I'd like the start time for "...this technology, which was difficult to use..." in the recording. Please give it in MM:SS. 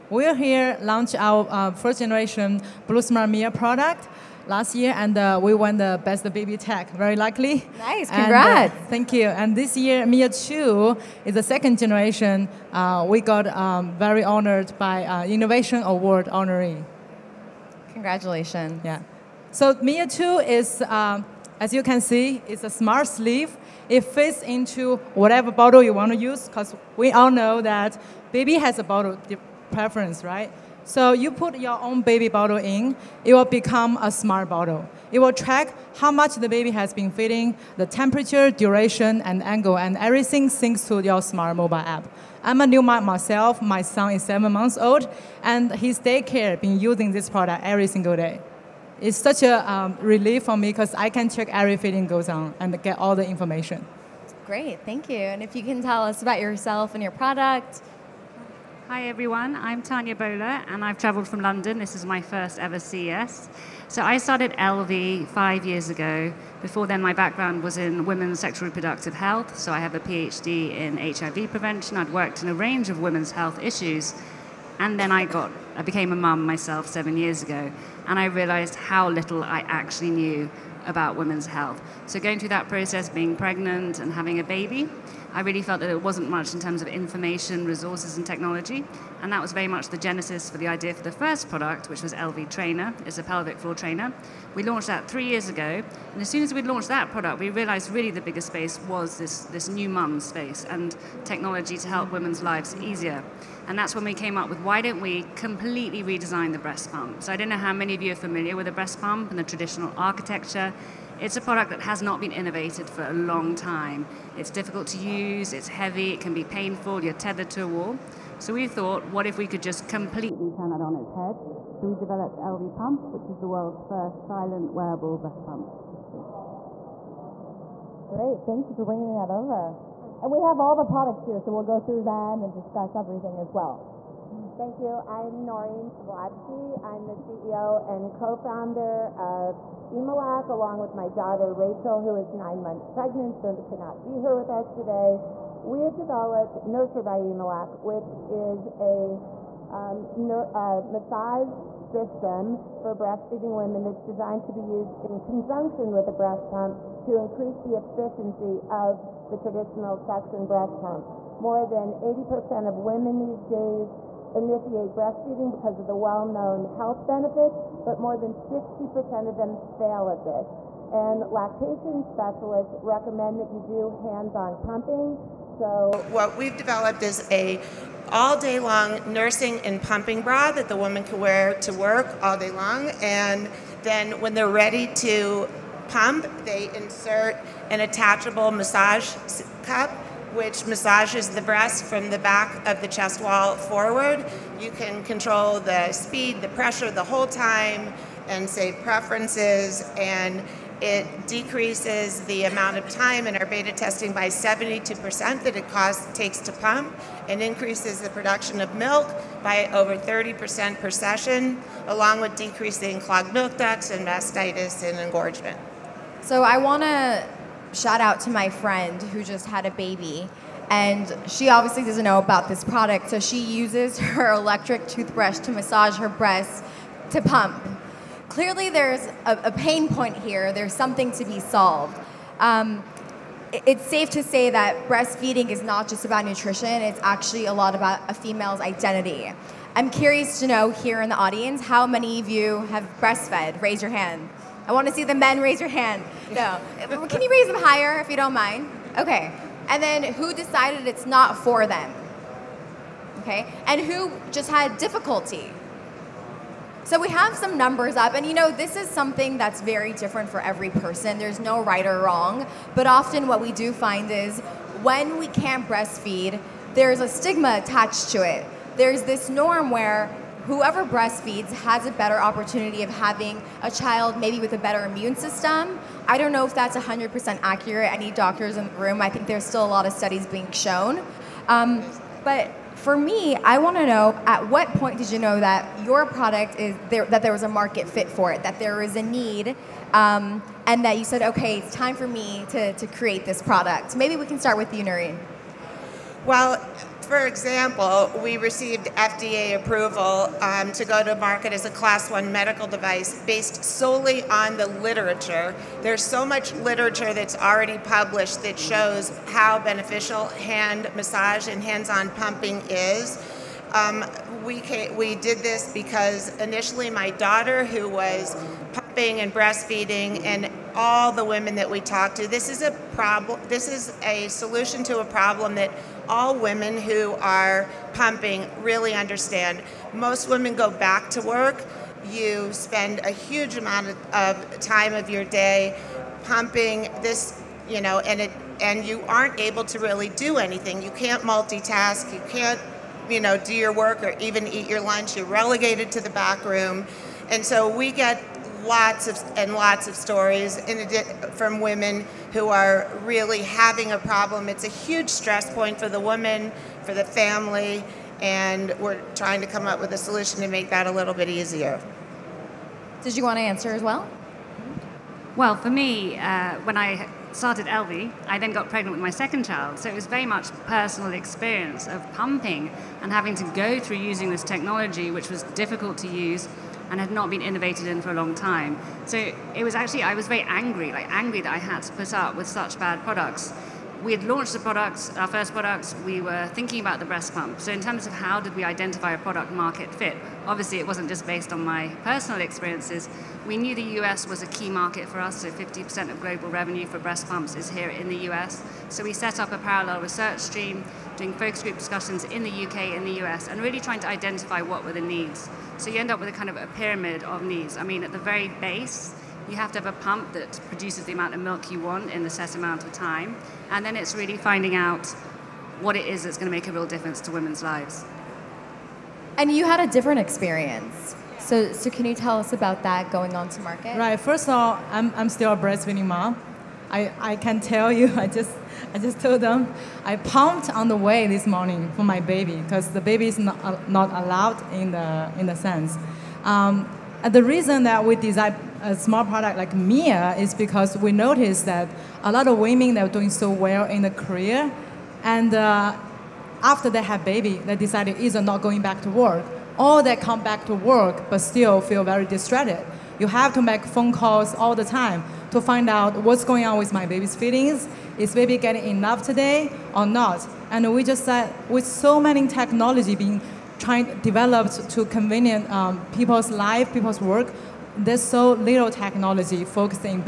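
06:14.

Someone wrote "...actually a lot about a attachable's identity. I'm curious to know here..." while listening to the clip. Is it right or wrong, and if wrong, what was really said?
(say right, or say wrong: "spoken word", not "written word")
wrong: "female", not "attachable".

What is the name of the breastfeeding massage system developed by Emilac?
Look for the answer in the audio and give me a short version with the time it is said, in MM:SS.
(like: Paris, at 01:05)
Nurture, at 02:26.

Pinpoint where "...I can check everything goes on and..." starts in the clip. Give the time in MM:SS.
00:50.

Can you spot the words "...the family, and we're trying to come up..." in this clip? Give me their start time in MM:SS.
05:56.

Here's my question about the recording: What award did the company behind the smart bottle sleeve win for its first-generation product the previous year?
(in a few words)
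Best baby tech.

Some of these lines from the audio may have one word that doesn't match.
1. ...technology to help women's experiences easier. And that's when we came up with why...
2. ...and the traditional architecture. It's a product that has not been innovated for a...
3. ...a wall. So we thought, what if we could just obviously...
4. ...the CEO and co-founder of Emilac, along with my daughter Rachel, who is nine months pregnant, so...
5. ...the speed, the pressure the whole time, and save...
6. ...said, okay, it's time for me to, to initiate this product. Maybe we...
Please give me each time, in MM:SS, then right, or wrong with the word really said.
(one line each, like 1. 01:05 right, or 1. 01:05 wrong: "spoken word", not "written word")
1. 01:41 wrong: "lives", not "experiences"
2. 01:49 right
3. 01:57 wrong: "completely", not "obviously"
4. 02:17 right
5. 03:15 right
6. 04:51 wrong: "create", not "initiate".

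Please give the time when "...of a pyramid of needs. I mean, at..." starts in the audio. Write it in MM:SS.
06:46.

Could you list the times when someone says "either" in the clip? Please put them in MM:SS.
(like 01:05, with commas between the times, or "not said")
07:28.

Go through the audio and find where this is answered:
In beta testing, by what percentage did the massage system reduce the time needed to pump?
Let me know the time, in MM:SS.
03:24.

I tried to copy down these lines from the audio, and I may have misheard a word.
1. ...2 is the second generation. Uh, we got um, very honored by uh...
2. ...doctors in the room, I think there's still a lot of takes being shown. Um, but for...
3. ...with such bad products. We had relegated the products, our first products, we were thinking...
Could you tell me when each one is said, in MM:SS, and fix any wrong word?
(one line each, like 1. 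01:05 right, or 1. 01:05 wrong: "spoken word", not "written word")
1. 00:10 right
2. 04:38 wrong: "studies", not "takes"
3. 06:22 wrong: "launched", not "relegated".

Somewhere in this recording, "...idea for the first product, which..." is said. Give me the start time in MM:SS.
01:30.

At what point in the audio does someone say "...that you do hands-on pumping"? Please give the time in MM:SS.
02:53.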